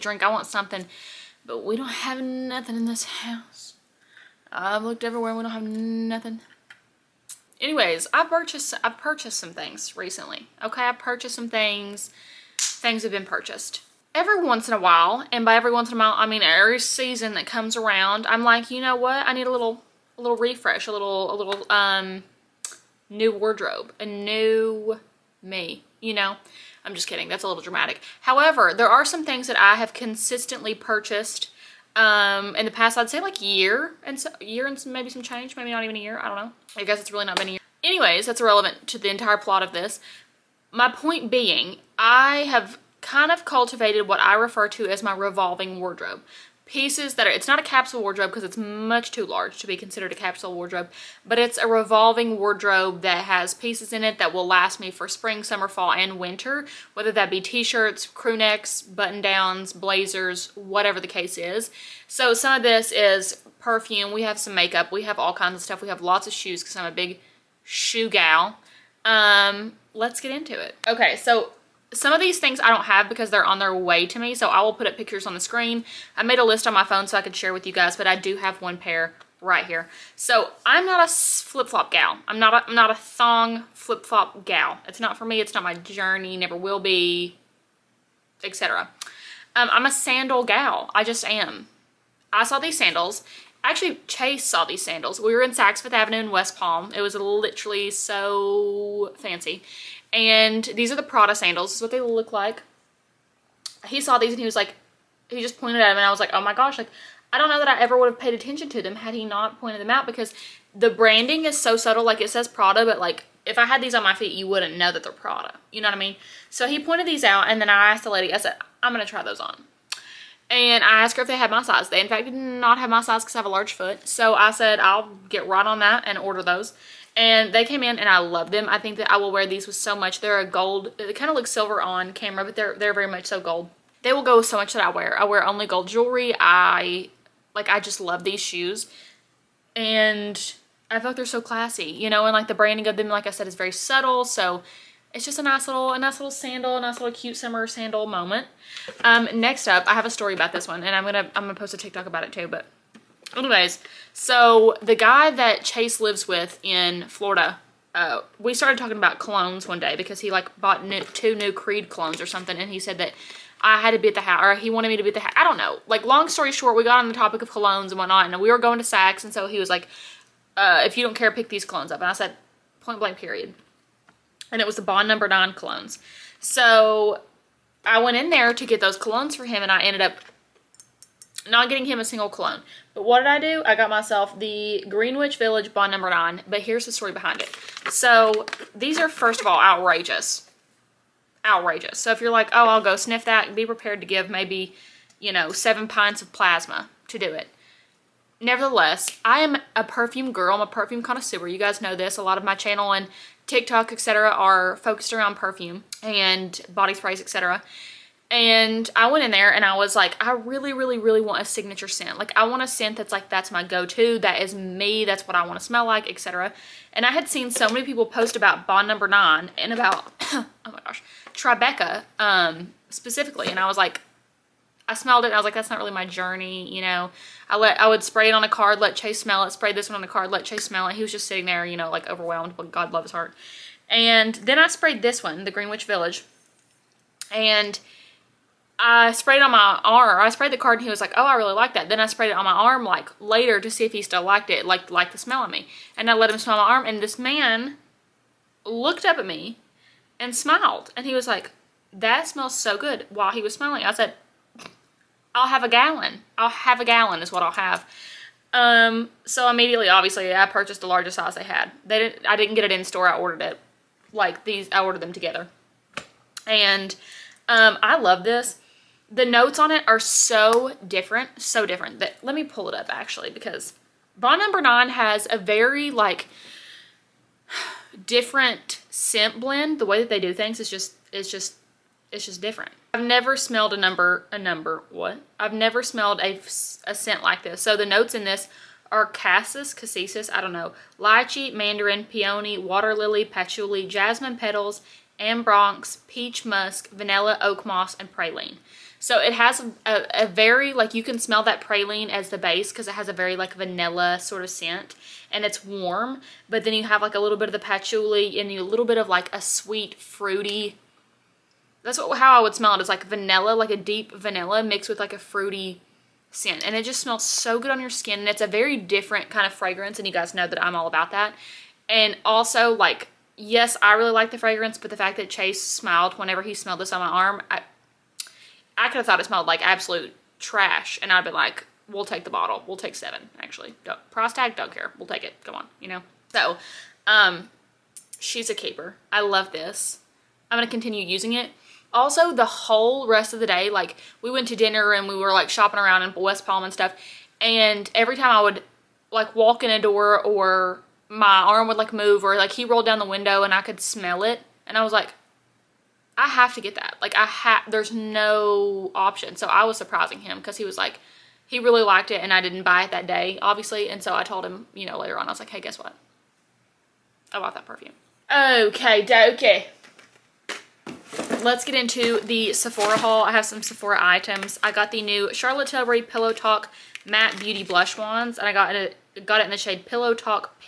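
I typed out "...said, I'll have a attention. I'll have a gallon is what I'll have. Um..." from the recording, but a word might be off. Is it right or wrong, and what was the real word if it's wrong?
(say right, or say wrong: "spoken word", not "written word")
wrong: "gallon", not "attention".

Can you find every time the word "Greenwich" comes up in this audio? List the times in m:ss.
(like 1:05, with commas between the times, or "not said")
3:04, 3:55.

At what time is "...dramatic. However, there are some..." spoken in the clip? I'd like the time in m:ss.
0:27.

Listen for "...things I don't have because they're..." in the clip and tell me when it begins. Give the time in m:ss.
1:12.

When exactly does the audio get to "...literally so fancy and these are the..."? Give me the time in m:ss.
1:37.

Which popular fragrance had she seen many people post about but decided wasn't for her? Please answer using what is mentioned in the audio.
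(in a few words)
Tribeca.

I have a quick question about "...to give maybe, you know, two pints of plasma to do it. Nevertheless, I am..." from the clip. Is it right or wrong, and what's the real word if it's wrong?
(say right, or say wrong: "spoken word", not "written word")
wrong: "seven", not "two".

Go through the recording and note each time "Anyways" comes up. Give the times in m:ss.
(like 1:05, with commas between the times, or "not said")
0:07, 0:37, 2:33.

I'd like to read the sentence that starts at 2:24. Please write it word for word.
So it's just a nice little, a nice little sandal, a nice little cute summer sandal moment.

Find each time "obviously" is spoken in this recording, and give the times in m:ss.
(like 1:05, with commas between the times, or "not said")
4:19, 6:03.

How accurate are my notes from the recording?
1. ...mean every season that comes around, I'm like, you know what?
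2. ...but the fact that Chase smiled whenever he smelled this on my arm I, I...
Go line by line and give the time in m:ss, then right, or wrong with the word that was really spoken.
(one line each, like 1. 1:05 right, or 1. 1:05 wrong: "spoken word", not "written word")
1. 0:16 right
2. 5:24 right.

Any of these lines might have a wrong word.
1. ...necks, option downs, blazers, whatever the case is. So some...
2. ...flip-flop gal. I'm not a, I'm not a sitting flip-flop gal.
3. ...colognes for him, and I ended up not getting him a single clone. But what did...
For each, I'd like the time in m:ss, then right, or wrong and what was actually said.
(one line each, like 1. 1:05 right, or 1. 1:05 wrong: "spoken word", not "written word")
1. 0:58 wrong: "button", not "option"
2. 1:21 wrong: "thong", not "sitting"
3. 2:58 right.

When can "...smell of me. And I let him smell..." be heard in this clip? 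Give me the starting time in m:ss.
4:05.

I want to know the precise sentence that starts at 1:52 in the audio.
Like it says Prada, but like if I had these on my feet, you wouldn't know that they're Prada.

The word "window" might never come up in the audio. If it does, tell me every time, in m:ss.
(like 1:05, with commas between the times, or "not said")
5:53.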